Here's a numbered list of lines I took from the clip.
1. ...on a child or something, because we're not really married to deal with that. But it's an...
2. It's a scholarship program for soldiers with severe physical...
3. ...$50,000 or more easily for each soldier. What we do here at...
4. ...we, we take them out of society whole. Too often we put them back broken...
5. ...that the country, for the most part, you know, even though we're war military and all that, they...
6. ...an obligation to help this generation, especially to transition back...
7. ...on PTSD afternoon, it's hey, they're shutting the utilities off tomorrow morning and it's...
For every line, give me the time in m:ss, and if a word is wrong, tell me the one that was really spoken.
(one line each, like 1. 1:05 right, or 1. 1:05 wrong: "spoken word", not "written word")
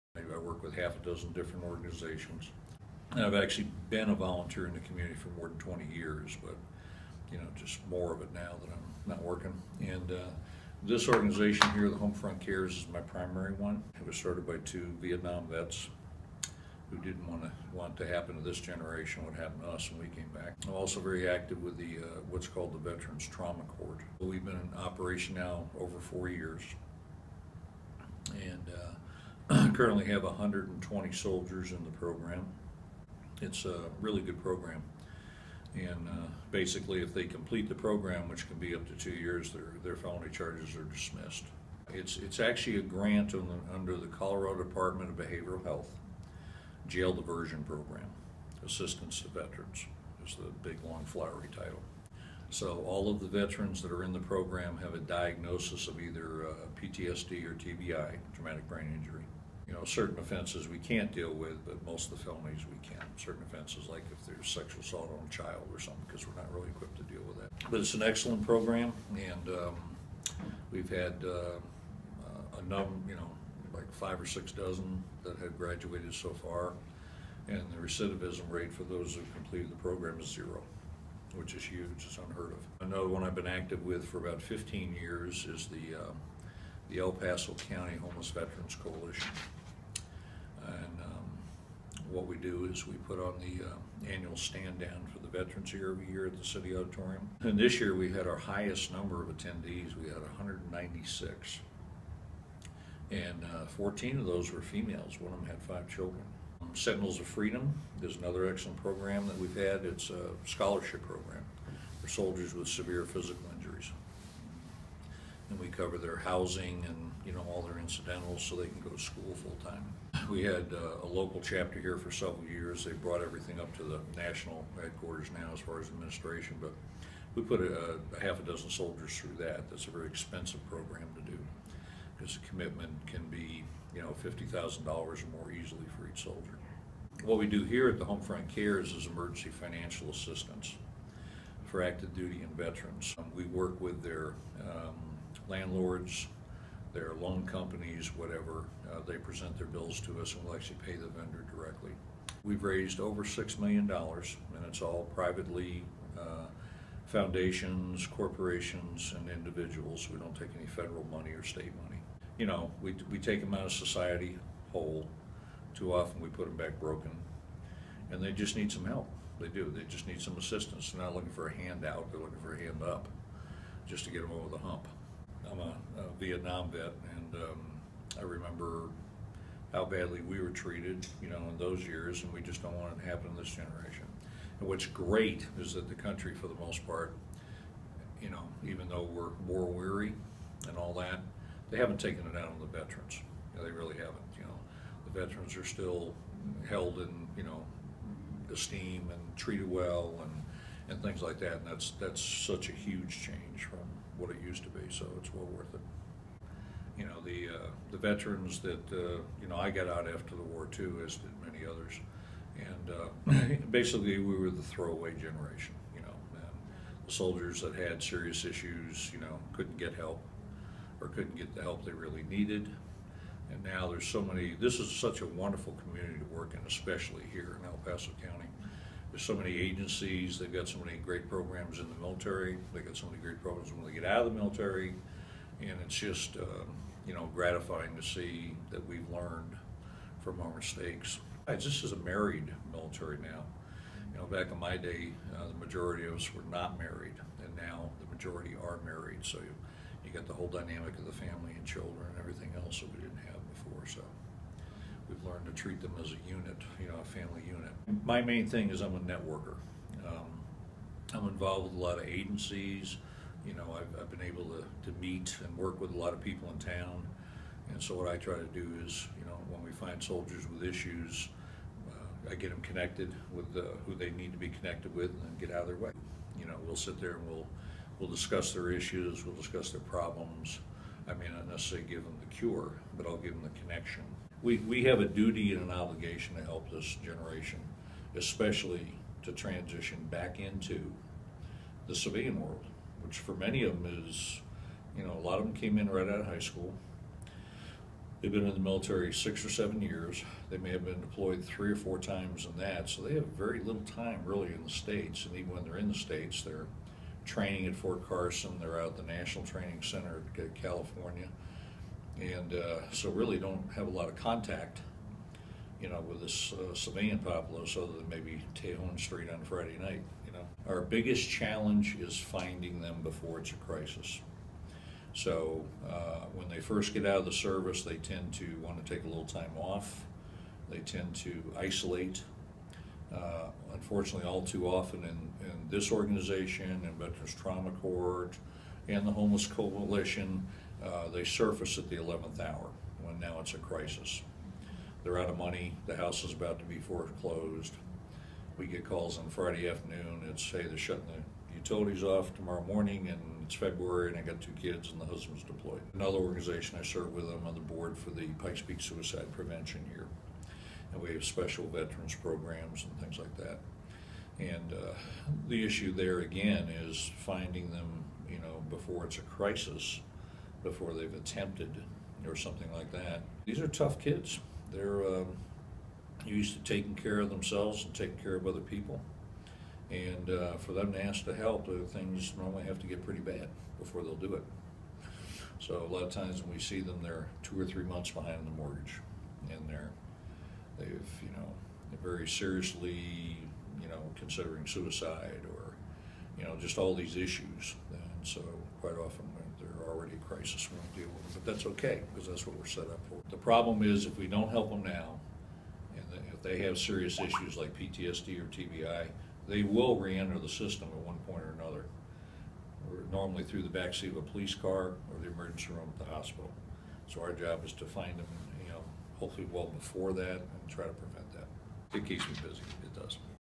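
1. 1:05 wrong: "equipped", not "married"
2. 1:49 right
3. 2:14 right
4. 2:42 right
5. 3:05 wrong: "weary", not "military"
6. 4:45 right
7. 5:49 wrong: "Friday", not "PTSD".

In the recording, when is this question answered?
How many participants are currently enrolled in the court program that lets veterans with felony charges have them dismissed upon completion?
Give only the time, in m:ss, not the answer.
0:30.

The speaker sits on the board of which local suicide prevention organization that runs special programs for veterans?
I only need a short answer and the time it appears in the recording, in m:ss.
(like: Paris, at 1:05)
Pikes Peak Suicide Prevention, at 5:58.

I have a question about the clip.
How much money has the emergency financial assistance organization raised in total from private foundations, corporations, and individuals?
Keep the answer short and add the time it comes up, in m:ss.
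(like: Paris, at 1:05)
$6 million, at 2:33.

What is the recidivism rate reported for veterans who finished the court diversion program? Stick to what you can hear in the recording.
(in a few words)
0.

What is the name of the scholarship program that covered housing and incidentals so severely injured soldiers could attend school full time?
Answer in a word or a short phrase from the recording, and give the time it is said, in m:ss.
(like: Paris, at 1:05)
Sentinels of Freedom, at 1:46.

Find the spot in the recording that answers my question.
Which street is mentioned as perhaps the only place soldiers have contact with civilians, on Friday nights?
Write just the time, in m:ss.
5:18.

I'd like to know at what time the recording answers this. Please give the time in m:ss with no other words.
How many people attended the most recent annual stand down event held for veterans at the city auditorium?
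1:40.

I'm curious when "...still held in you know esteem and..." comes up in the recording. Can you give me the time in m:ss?
3:15.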